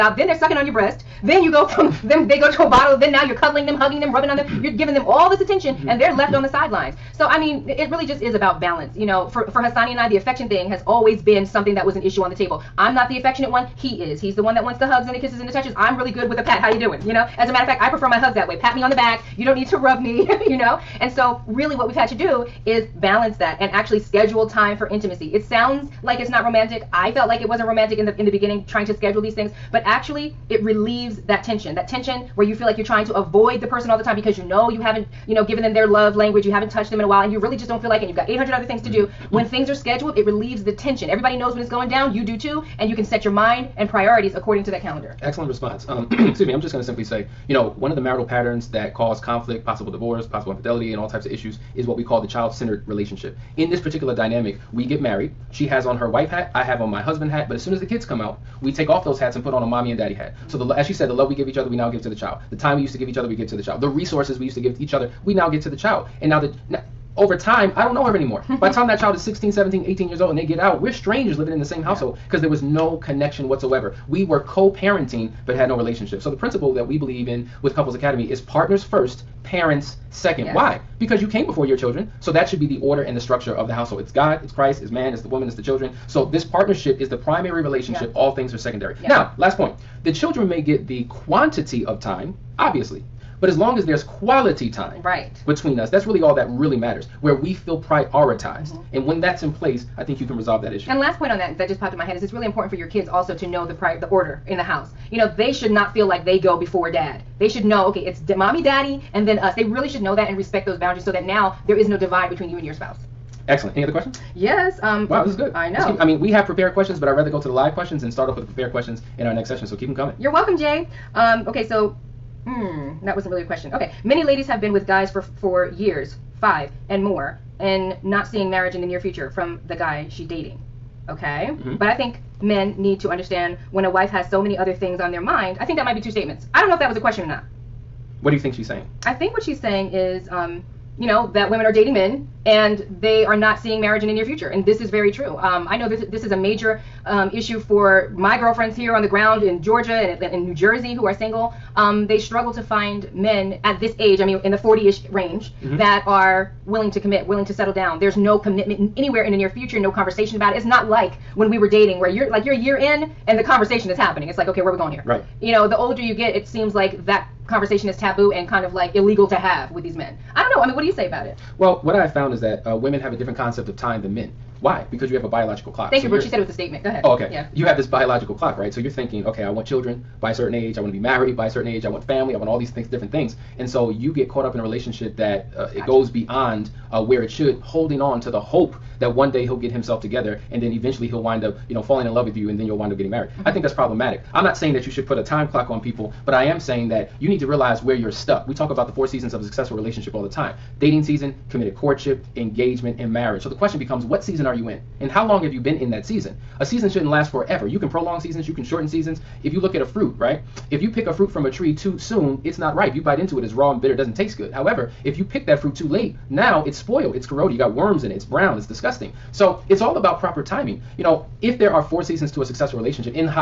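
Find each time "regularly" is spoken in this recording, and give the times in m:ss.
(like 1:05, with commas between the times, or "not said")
not said.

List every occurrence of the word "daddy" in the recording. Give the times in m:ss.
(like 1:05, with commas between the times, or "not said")
0:59, 1:48.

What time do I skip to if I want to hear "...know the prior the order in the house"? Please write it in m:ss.
1:43.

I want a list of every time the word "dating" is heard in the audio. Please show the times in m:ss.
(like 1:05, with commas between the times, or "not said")
2:10, 2:21, 2:41, 3:20.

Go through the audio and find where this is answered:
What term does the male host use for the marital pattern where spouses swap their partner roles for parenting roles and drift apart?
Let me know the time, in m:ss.
0:52.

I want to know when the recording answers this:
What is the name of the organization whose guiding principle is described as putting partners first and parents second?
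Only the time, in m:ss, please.
1:17.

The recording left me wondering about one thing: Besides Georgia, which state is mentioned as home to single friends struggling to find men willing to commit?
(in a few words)
New Jersey.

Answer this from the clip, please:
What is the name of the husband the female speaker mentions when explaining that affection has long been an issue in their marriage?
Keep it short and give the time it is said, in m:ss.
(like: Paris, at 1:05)
Hasani, at 0:09.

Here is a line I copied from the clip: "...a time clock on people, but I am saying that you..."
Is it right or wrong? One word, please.
right.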